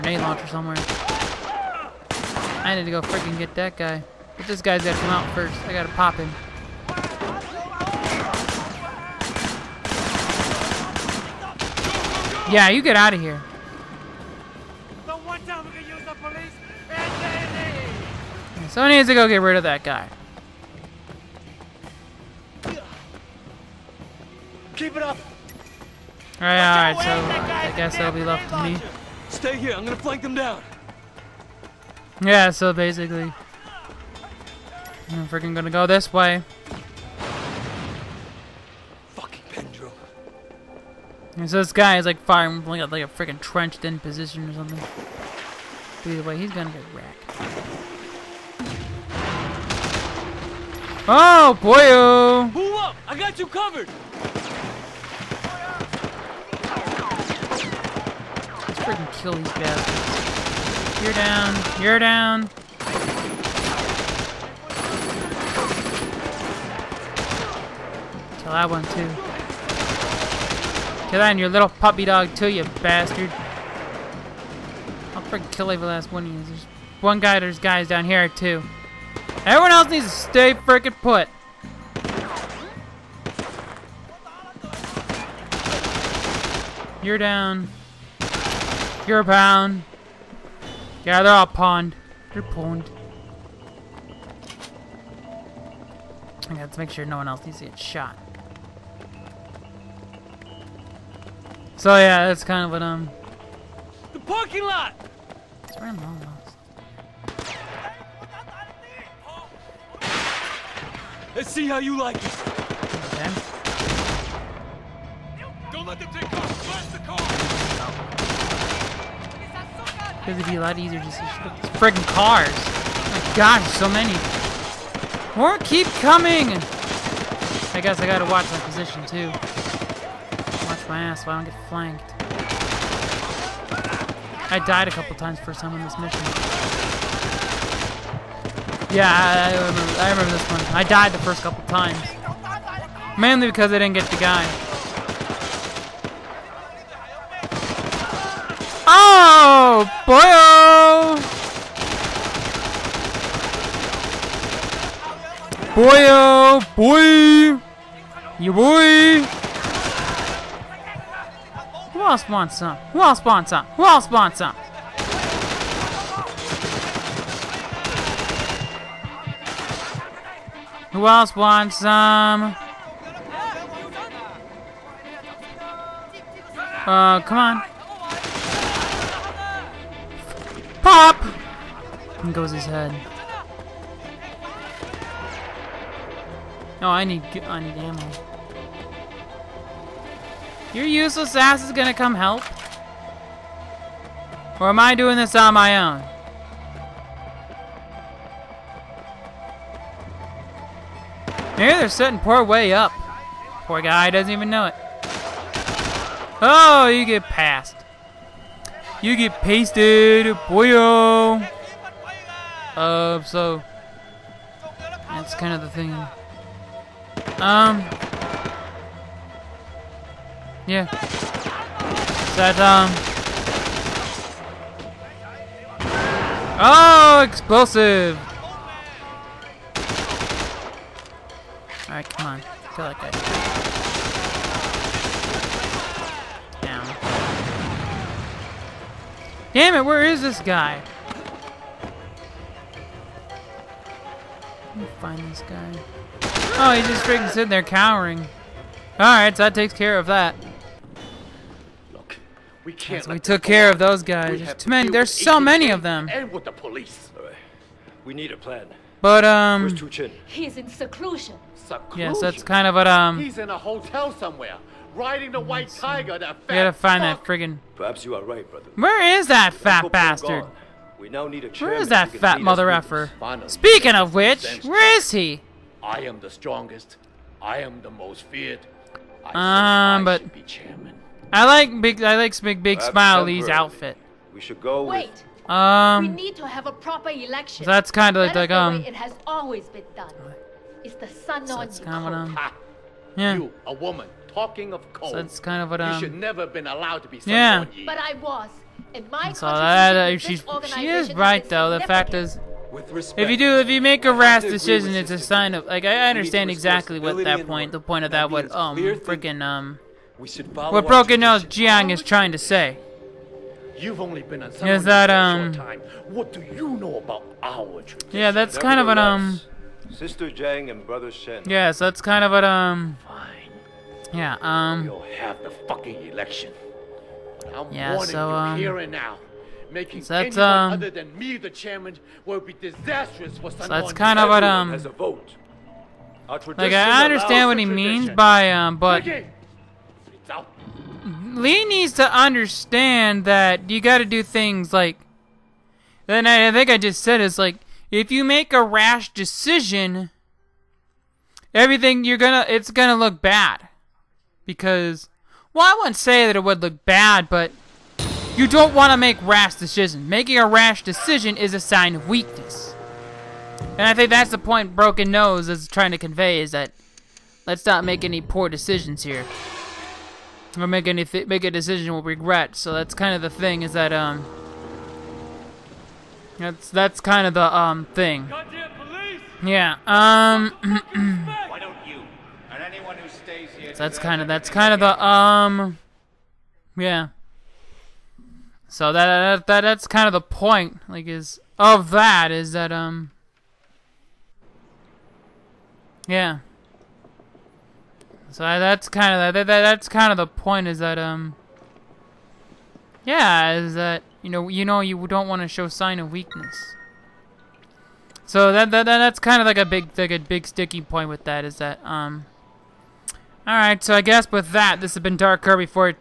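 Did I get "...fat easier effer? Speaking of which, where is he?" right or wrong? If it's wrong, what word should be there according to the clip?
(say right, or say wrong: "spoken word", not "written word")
wrong: "mother", not "easier".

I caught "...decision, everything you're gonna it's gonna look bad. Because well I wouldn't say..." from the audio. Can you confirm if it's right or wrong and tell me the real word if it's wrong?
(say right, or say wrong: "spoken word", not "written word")
right.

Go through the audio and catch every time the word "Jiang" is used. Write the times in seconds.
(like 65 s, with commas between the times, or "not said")
311 s, 320 s.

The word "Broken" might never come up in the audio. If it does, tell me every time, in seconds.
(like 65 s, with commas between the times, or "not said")
310 s, 364 s.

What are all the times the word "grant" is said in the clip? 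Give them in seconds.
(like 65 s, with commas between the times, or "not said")
not said.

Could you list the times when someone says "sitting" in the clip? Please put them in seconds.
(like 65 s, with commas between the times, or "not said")
201 s, 247 s.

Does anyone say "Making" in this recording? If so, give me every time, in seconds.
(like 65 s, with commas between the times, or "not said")
329 s, 360 s.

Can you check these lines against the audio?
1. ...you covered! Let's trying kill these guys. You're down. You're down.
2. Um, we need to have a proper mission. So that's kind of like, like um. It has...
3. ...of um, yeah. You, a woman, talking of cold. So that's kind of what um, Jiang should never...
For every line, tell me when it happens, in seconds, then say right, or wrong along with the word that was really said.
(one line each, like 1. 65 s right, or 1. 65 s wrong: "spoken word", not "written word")
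1. 53 s wrong: "freaking", not "trying"
2. 285 s wrong: "election", not "mission"
3. 292 s wrong: "You", not "Jiang".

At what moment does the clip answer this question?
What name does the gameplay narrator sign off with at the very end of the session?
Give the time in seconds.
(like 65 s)
415 s.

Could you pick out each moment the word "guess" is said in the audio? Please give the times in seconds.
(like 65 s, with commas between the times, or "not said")
27 s, 127 s, 414 s.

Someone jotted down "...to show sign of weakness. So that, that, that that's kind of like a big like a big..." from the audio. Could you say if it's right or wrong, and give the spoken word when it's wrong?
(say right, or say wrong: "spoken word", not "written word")
right.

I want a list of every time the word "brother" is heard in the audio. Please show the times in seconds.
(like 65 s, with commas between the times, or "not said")
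268 s, 320 s.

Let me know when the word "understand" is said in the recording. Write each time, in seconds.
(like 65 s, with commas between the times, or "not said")
306 s, 337 s, 342 s.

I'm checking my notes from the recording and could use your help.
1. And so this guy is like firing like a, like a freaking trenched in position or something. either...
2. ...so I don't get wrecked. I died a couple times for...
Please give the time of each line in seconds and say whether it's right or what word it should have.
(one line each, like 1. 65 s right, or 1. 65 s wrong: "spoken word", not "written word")
1. 41 s right
2. 131 s wrong: "flanked", not "wrecked".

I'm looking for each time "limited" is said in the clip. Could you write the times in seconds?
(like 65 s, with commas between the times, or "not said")
not said.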